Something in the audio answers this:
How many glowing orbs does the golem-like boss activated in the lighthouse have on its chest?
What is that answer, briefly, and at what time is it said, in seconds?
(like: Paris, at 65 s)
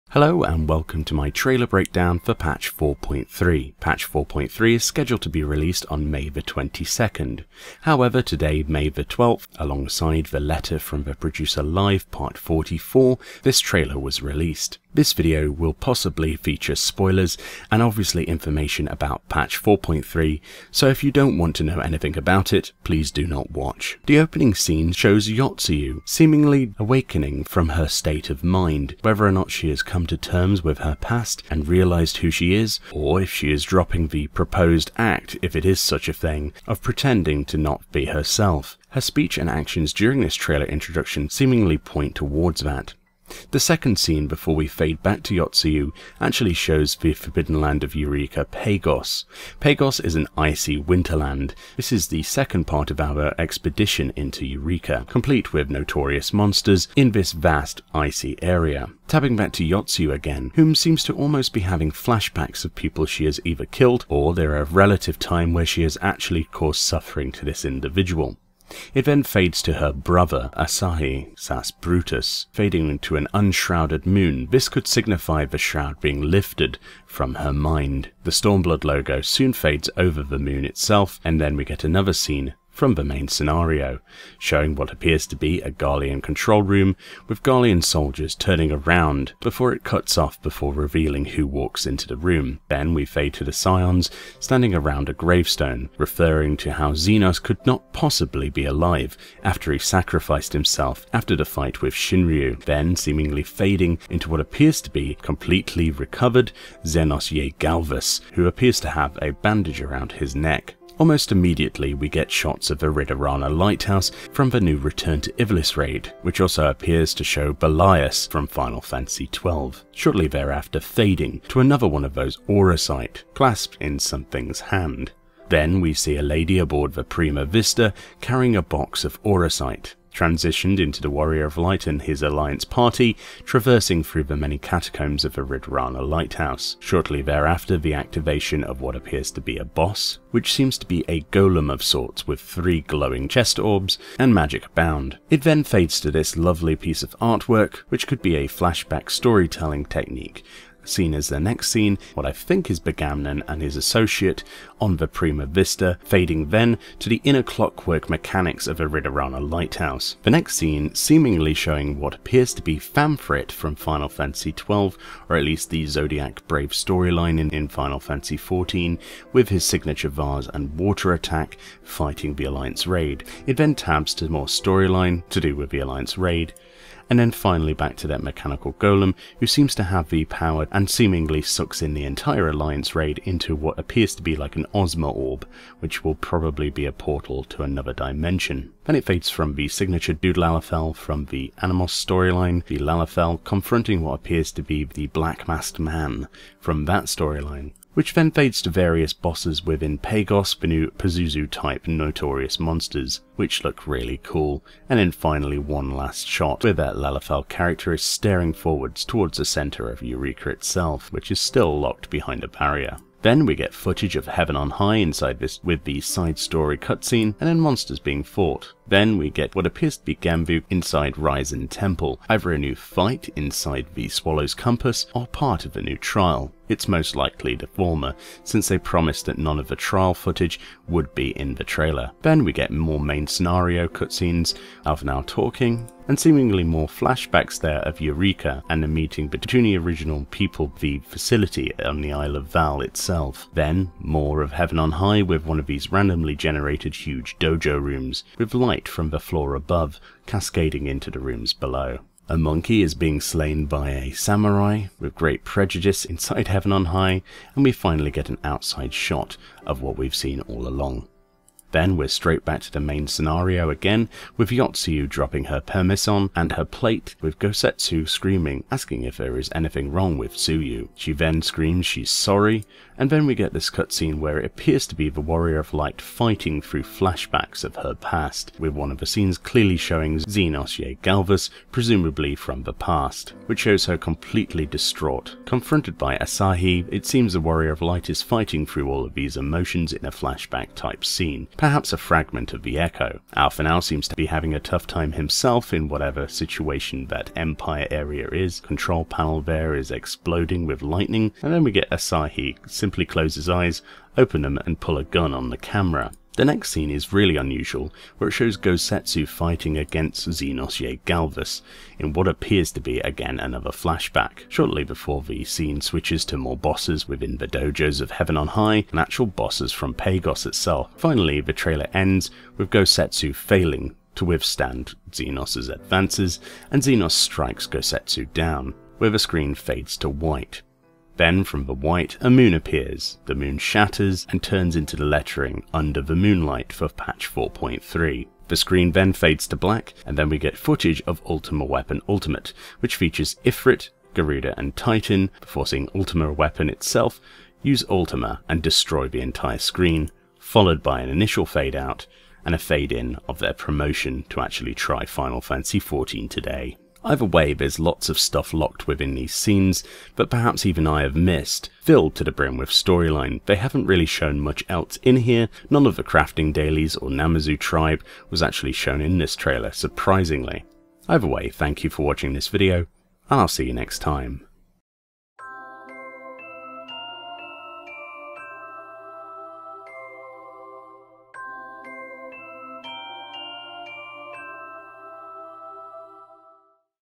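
3, at 142 s.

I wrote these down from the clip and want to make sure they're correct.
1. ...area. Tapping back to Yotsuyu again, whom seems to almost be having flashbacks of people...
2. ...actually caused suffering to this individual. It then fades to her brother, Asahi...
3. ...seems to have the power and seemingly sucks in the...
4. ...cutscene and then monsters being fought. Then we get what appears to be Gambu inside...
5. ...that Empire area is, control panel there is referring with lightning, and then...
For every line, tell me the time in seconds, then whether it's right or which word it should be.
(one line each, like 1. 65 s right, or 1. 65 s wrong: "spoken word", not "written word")
1. 58 s right
2. 66 s right
3. 179 s right
4. 216 s right
5. 297 s wrong: "exploding", not "referring".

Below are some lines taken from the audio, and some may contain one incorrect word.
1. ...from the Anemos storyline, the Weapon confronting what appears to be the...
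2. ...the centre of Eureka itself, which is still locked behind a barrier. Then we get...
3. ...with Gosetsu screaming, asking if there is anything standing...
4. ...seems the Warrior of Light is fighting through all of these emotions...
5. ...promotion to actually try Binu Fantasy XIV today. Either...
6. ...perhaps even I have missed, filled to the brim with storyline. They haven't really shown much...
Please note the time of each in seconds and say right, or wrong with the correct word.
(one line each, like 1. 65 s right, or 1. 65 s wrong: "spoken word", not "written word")
1. 190 s wrong: "Lalafell", not "Weapon"
2. 209 s right
3. 267 s wrong: "wrong", not "standing"
4. 287 s right
5. 353 s wrong: "Final", not "Binu"
6. 360 s right.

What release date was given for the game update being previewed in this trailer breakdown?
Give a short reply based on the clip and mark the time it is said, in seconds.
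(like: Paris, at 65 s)
May 22nd, at 6 s.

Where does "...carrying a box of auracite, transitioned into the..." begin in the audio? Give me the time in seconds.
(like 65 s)
128 s.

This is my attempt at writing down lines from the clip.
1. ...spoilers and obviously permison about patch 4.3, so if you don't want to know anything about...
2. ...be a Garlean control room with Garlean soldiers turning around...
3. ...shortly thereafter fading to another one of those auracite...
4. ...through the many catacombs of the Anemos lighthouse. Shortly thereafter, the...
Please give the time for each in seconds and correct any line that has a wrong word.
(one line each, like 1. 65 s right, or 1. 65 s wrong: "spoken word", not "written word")
1. 16 s wrong: "information", not "permison"
2. 85 s right
3. 119 s right
4. 134 s wrong: "Ridorana", not "Anemos".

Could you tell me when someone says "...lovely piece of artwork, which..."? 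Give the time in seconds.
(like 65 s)
146 s.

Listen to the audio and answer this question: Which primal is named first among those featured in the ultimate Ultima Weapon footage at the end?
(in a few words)
Ifrit.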